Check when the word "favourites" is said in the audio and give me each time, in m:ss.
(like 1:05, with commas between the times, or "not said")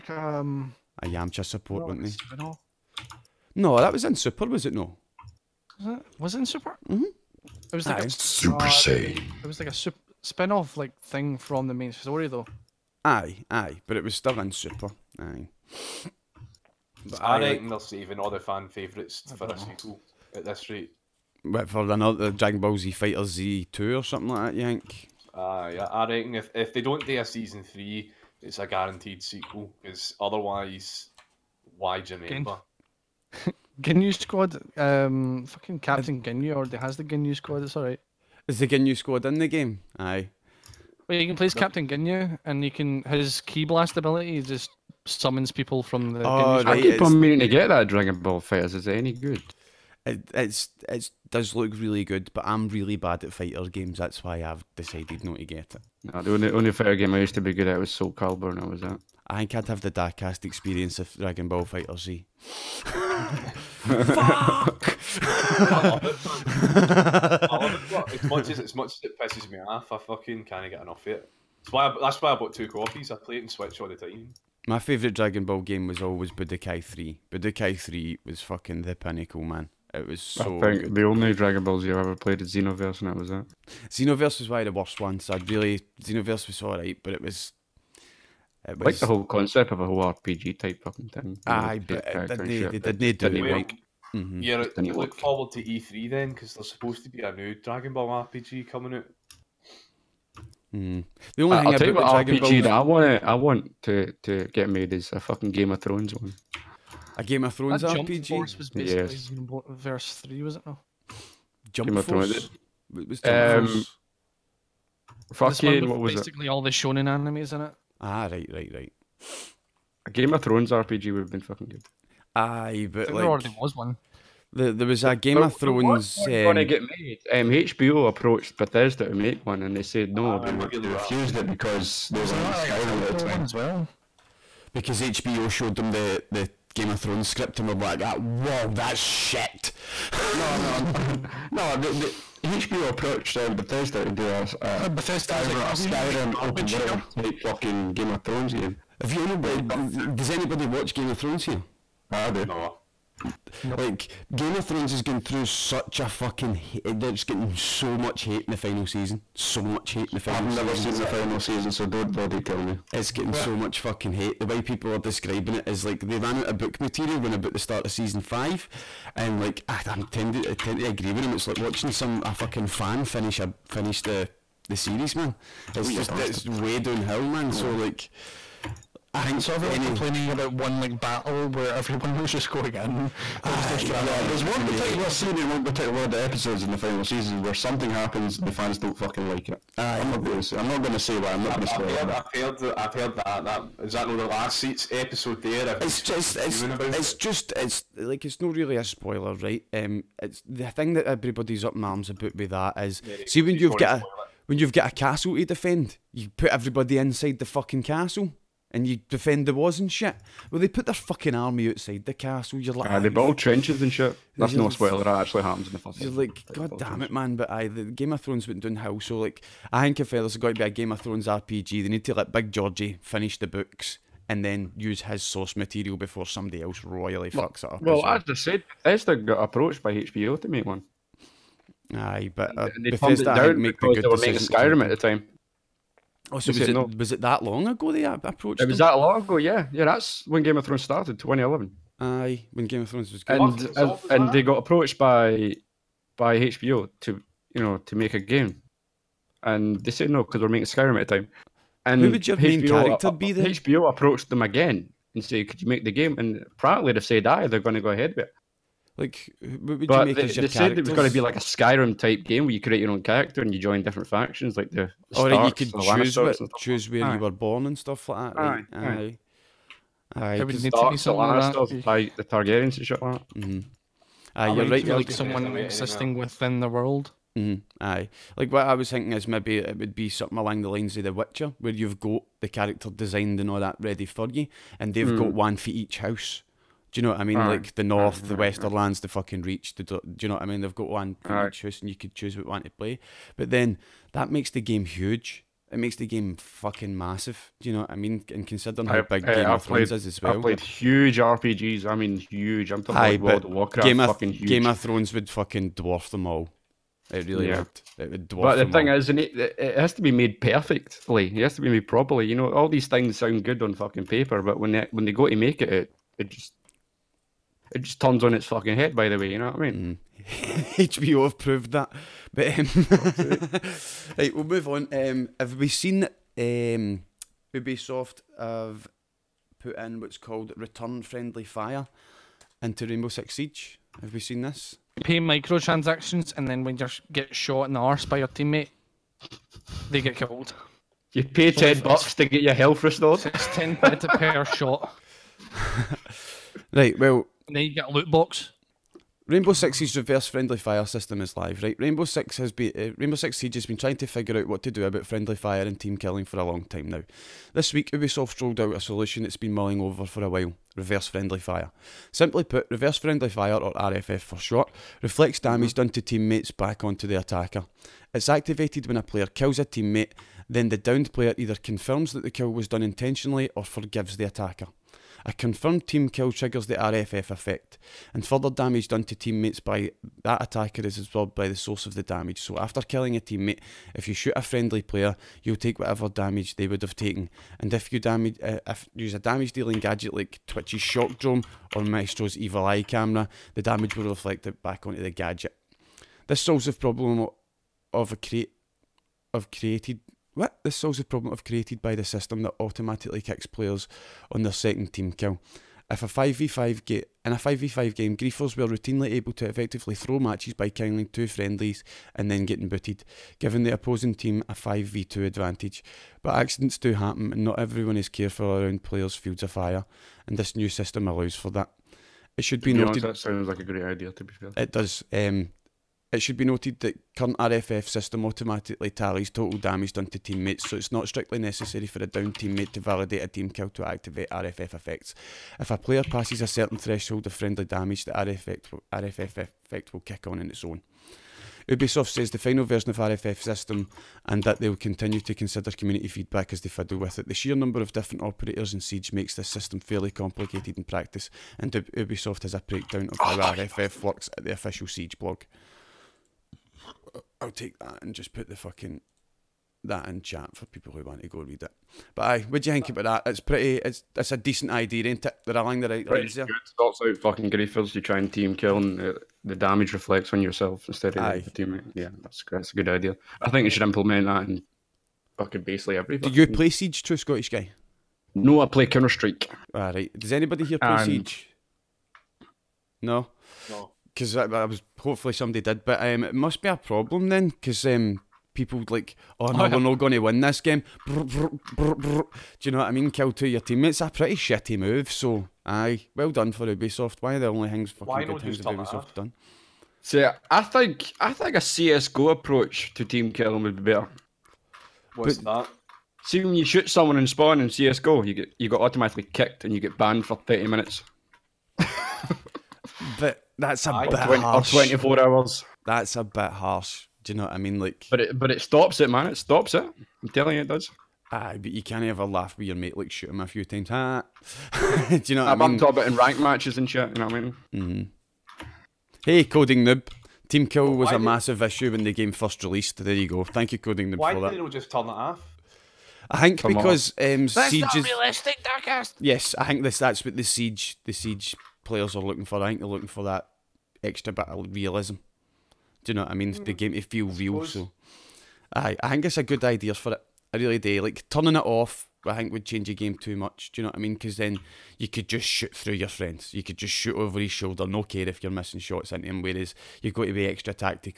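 0:18, 1:14.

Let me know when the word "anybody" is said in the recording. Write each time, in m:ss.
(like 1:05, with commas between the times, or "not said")
2:30, 8:00.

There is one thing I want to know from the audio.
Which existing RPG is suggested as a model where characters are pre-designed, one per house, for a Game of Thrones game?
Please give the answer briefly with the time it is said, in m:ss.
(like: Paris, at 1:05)
The Witcher, at 4:41.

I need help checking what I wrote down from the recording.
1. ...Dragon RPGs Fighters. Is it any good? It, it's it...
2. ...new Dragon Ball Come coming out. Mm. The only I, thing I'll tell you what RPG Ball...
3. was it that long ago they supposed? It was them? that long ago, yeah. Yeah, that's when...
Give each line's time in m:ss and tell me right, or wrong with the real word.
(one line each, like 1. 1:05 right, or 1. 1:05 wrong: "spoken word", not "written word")
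1. 0:47 wrong: "Ball", not "RPGs"
2. 1:37 wrong: "RPG", not "Come"
3. 3:56 wrong: "approached", not "supposed".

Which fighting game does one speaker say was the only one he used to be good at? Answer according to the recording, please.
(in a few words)
Soul Calibur.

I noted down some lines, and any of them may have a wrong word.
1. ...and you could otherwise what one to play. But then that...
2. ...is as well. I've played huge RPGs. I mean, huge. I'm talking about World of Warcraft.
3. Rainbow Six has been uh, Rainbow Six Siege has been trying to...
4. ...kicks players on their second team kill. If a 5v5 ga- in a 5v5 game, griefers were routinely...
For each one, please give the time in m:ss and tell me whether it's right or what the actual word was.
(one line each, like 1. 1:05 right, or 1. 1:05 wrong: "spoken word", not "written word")
1. 4:51 wrong: "choose", not "otherwise"
2. 5:00 right
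3. 5:51 right
4. 6:43 right.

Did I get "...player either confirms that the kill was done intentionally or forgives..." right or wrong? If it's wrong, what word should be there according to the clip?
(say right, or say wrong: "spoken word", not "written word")
right.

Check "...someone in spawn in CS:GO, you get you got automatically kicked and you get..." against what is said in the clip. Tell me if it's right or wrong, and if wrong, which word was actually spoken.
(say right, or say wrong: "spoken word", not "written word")
right.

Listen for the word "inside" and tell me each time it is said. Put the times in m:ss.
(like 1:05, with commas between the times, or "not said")
3:26.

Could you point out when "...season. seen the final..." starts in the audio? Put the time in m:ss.
2:40.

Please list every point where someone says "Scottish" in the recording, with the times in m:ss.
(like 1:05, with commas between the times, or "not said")
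7:57.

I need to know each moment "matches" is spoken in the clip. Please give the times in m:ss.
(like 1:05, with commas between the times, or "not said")
6:50, 8:46.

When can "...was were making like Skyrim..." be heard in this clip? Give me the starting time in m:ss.
2:12.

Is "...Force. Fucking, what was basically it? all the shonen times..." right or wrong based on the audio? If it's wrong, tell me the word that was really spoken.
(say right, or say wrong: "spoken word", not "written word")
wrong: "animes", not "times".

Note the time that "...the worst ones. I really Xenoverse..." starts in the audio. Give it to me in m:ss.
1:24.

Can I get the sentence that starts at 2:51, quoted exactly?
It's like watching some a fucking fan finish a finish the the series, man.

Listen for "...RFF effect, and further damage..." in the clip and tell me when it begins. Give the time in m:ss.
6:16.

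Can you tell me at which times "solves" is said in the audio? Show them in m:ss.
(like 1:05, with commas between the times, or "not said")
6:36, 6:40.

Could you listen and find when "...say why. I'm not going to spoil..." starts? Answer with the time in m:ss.
3:10.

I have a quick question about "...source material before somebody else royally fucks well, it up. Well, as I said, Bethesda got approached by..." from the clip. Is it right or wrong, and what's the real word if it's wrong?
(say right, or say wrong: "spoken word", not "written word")
right.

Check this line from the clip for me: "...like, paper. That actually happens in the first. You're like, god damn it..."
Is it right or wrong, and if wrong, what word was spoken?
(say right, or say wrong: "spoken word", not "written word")
wrong: "spoiler", not "paper".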